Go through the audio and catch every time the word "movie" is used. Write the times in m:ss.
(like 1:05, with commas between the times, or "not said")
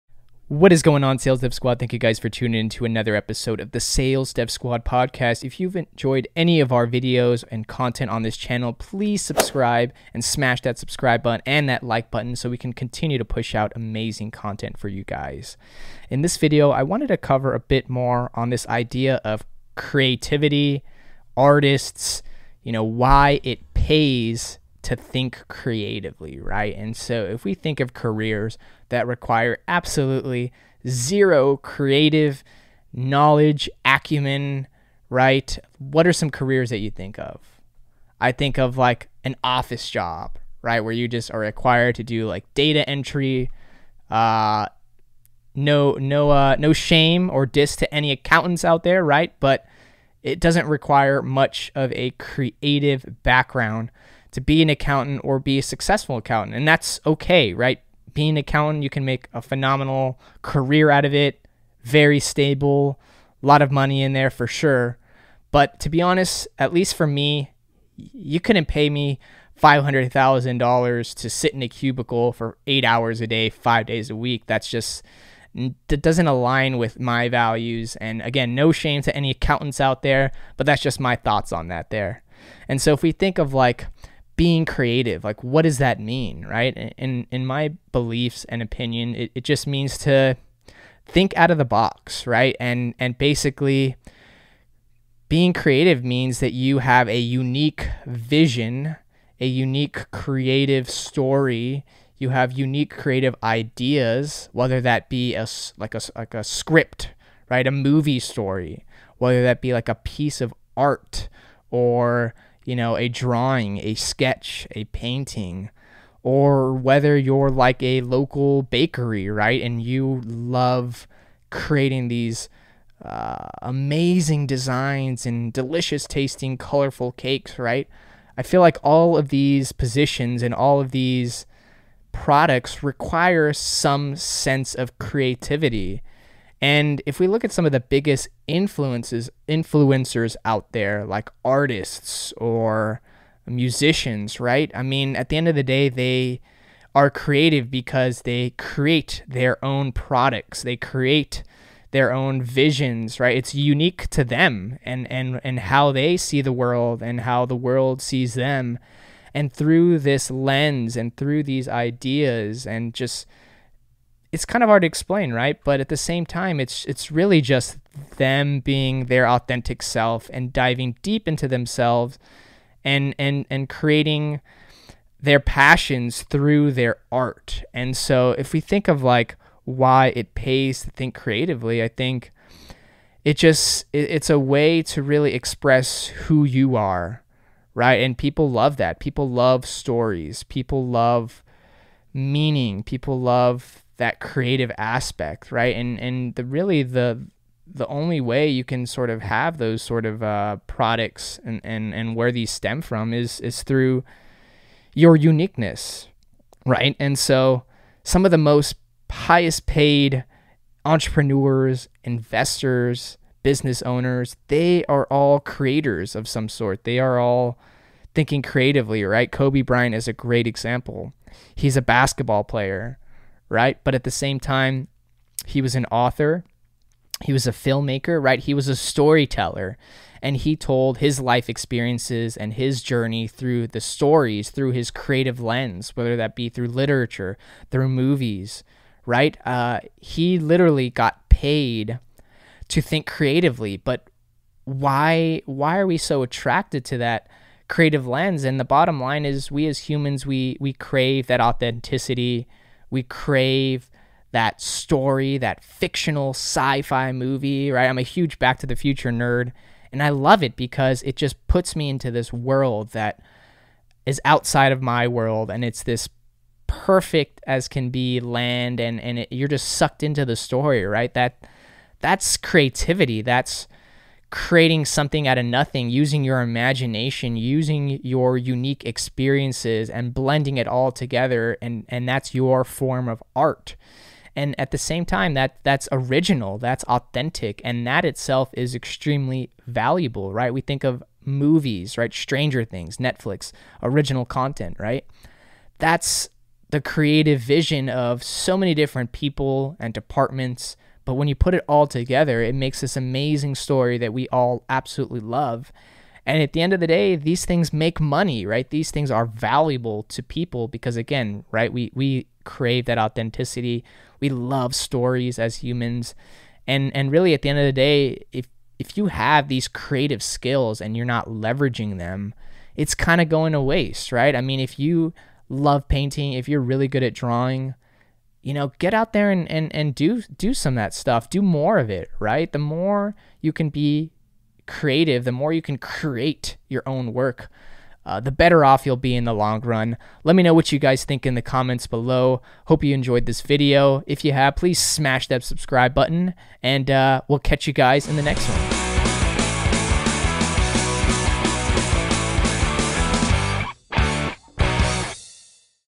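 1:47, 3:57, 4:17, 4:51.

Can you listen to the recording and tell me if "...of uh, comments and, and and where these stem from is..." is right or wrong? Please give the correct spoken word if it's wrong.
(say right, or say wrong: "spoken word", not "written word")
wrong: "products", not "comments".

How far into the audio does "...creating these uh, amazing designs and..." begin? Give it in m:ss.
2:01.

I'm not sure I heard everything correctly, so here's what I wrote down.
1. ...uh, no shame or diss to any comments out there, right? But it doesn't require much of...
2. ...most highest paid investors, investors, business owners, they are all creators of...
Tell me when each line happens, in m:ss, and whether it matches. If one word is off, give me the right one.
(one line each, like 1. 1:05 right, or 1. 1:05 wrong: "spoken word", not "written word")
1. 0:46 wrong: "accountants", not "comments"
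2. 3:28 wrong: "entrepreneurs", not "investors".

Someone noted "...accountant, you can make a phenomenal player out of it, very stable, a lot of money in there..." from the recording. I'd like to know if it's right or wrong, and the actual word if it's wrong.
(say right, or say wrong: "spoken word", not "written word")
wrong: "career", not "player".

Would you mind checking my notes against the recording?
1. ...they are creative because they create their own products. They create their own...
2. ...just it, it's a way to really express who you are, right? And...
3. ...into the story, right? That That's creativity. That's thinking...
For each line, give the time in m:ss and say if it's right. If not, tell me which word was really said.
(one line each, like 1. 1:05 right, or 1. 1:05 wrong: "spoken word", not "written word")
1. 2:25 right
2. 3:03 right
3. 4:30 wrong: "creating", not "thinking".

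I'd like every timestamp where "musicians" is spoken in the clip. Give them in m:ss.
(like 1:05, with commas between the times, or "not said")
2:23.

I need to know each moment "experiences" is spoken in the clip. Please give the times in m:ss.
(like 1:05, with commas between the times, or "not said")
3:51, 4:38.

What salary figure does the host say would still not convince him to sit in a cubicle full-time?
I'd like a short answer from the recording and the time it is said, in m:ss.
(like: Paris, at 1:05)
$500,000, at 1:09.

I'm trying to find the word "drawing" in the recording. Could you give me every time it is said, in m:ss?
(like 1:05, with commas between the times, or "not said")
1:53, 5:27.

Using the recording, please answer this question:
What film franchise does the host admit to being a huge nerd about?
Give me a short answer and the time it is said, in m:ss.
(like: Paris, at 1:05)
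Back to the Future, at 4:18.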